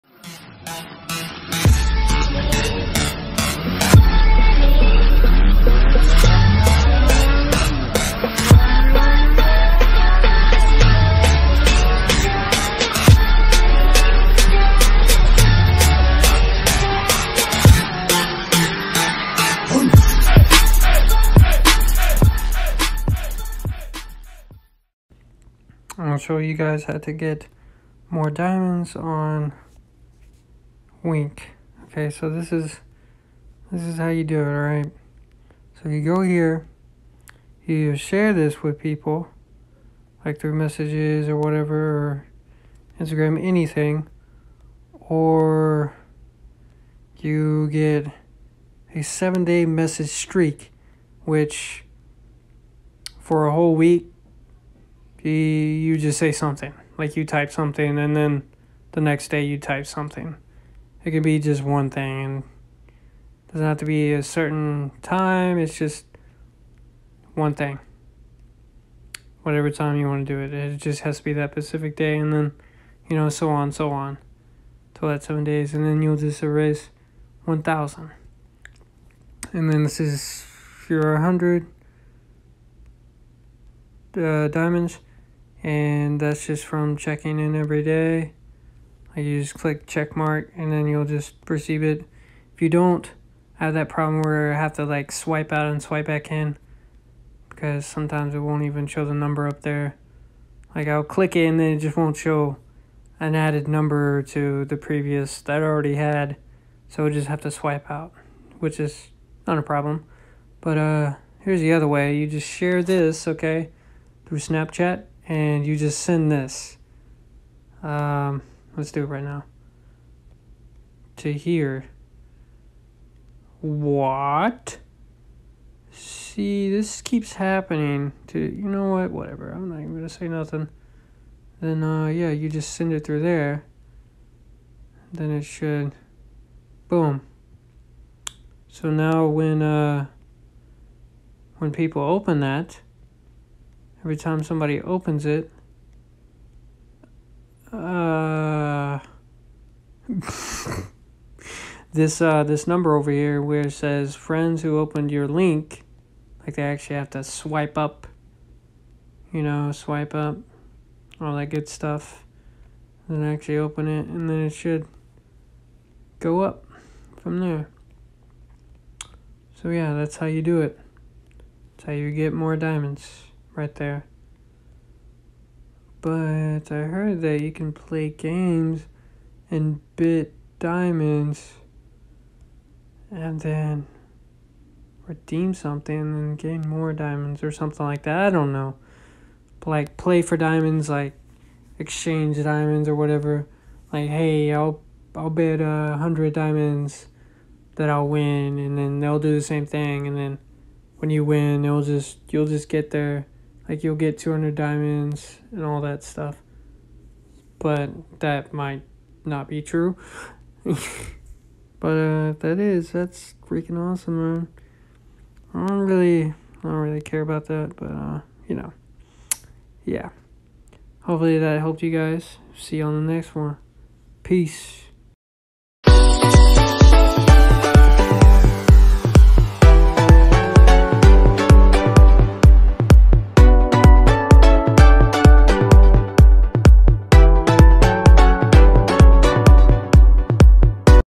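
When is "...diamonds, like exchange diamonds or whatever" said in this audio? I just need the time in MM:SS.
03:10.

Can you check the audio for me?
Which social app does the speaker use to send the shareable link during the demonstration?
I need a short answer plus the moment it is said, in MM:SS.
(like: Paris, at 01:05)
Snapchat, at 01:54.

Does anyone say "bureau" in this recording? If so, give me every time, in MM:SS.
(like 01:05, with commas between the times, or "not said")
not said.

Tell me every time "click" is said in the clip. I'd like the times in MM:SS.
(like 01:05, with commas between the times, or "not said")
01:29, 01:41.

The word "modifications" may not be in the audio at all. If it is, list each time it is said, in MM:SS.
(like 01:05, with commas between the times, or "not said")
not said.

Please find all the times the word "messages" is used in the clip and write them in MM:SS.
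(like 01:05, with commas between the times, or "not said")
00:40, 00:49.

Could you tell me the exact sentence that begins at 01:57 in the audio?
Um, let's do it right now.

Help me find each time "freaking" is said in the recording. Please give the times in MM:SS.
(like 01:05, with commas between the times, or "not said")
03:33.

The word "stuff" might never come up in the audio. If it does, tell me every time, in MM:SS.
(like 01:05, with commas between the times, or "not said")
02:41, 03:26.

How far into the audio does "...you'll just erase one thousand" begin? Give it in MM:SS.
01:16.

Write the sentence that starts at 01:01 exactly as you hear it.
It could be just one thing and doesn't have to be a certain time, it's just one thing.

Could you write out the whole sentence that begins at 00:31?
Okay, so this is this is how you do it, alright?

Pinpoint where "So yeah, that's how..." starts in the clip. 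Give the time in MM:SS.
02:49.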